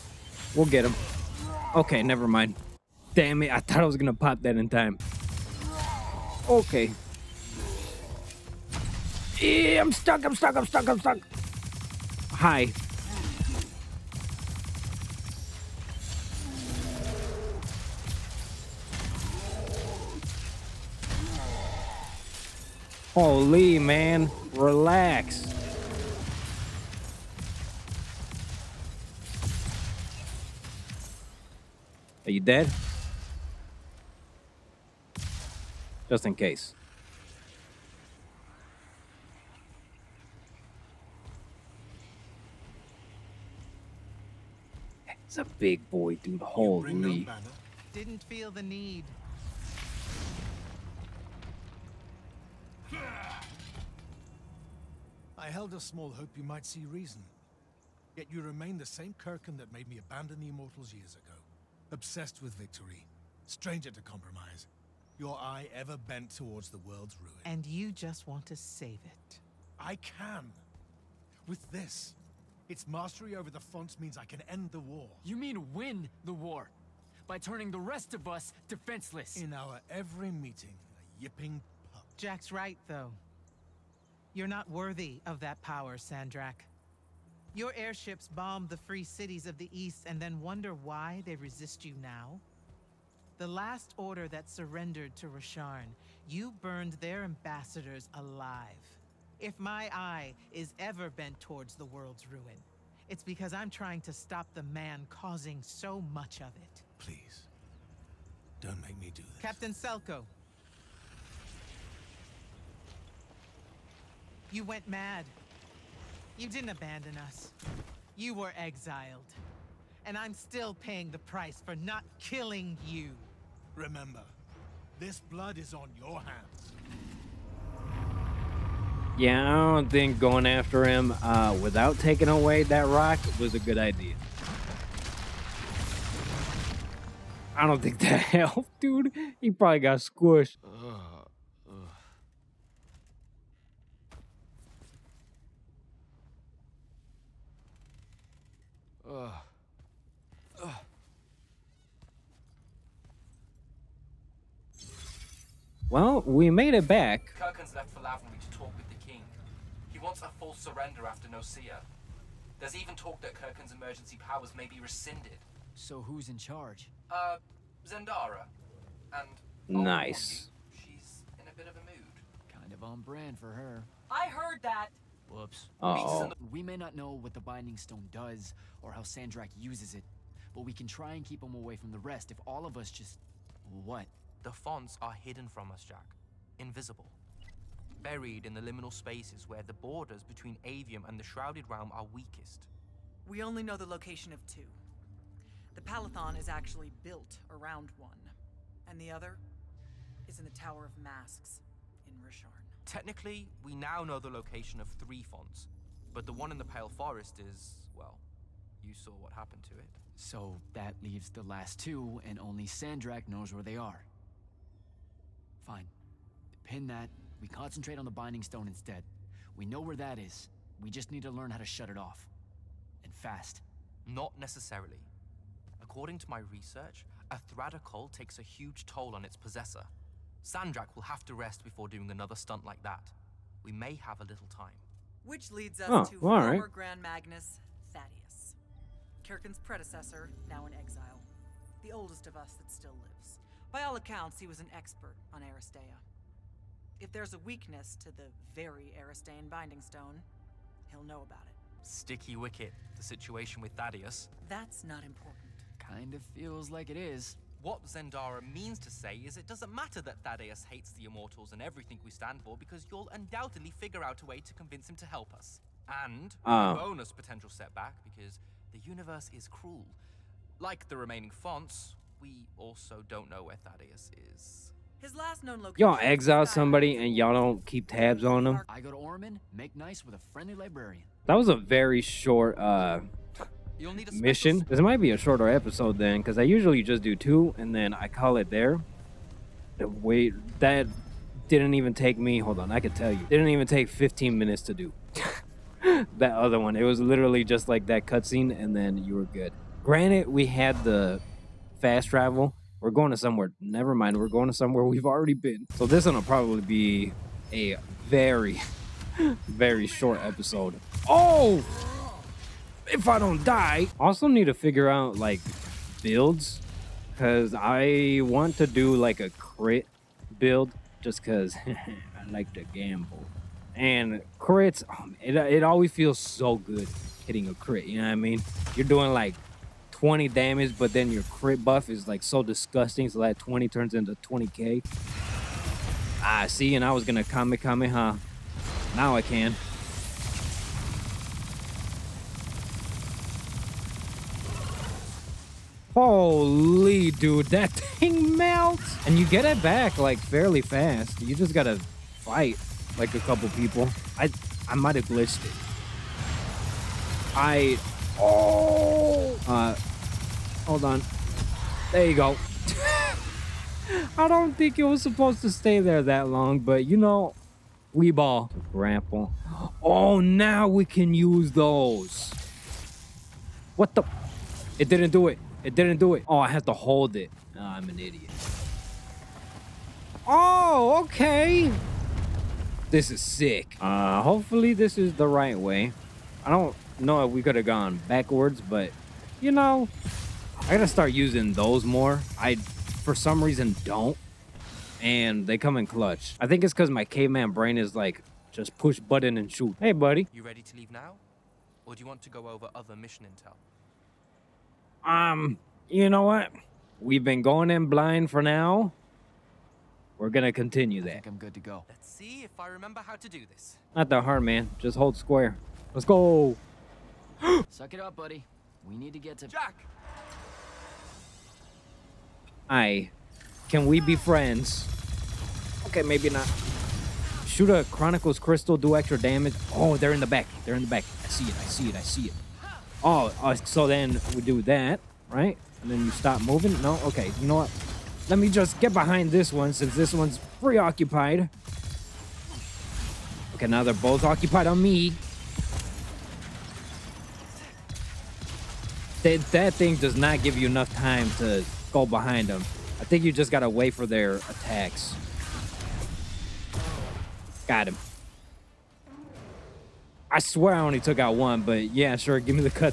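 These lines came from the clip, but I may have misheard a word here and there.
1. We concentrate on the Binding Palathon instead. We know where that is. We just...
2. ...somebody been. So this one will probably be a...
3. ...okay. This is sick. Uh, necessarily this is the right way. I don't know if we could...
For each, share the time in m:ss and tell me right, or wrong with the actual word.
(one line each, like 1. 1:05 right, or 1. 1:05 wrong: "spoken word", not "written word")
1. 3:37 wrong: "Stone", not "Palathon"
2. 5:05 wrong: "already", not "somebody"
3. 6:21 wrong: "hopefully", not "necessarily".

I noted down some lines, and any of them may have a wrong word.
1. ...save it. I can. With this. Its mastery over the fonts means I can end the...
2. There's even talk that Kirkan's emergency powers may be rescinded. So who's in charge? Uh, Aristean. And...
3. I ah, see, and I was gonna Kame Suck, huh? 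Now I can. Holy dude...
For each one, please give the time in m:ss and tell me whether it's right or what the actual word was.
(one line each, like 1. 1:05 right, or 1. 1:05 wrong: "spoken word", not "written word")
1. 1:08 right
2. 2:42 wrong: "Zendara", not "Aristean"
3. 5:36 wrong: "Kame", not "Suck".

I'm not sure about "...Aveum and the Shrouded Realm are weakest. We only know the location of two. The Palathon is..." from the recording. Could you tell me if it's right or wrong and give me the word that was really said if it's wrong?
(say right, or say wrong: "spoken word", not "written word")
right.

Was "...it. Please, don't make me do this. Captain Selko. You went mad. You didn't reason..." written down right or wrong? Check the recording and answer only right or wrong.
wrong.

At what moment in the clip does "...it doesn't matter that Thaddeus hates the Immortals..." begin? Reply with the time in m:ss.
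4:19.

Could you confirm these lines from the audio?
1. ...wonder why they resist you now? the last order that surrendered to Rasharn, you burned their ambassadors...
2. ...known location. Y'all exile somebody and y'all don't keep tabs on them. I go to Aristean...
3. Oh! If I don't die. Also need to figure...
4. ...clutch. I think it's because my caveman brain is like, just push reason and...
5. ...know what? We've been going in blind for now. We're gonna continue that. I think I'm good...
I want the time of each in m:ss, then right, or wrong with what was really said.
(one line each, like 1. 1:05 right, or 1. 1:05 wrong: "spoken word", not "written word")
1. 1:30 right
2. 4:35 wrong: "Ormond", not "Aristean"
3. 5:11 right
4. 6:35 wrong: "button", not "reason"
5. 6:46 right.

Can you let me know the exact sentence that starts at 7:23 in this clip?
Okay, now they're both occupied on me.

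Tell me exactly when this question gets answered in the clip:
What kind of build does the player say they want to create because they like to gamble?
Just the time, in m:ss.
5:19.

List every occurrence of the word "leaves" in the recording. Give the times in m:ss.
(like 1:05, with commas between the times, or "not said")
3:31, 6:40.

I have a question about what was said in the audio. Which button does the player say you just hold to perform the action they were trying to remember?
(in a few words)
square.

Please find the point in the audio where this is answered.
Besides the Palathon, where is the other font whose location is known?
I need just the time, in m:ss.
3:20.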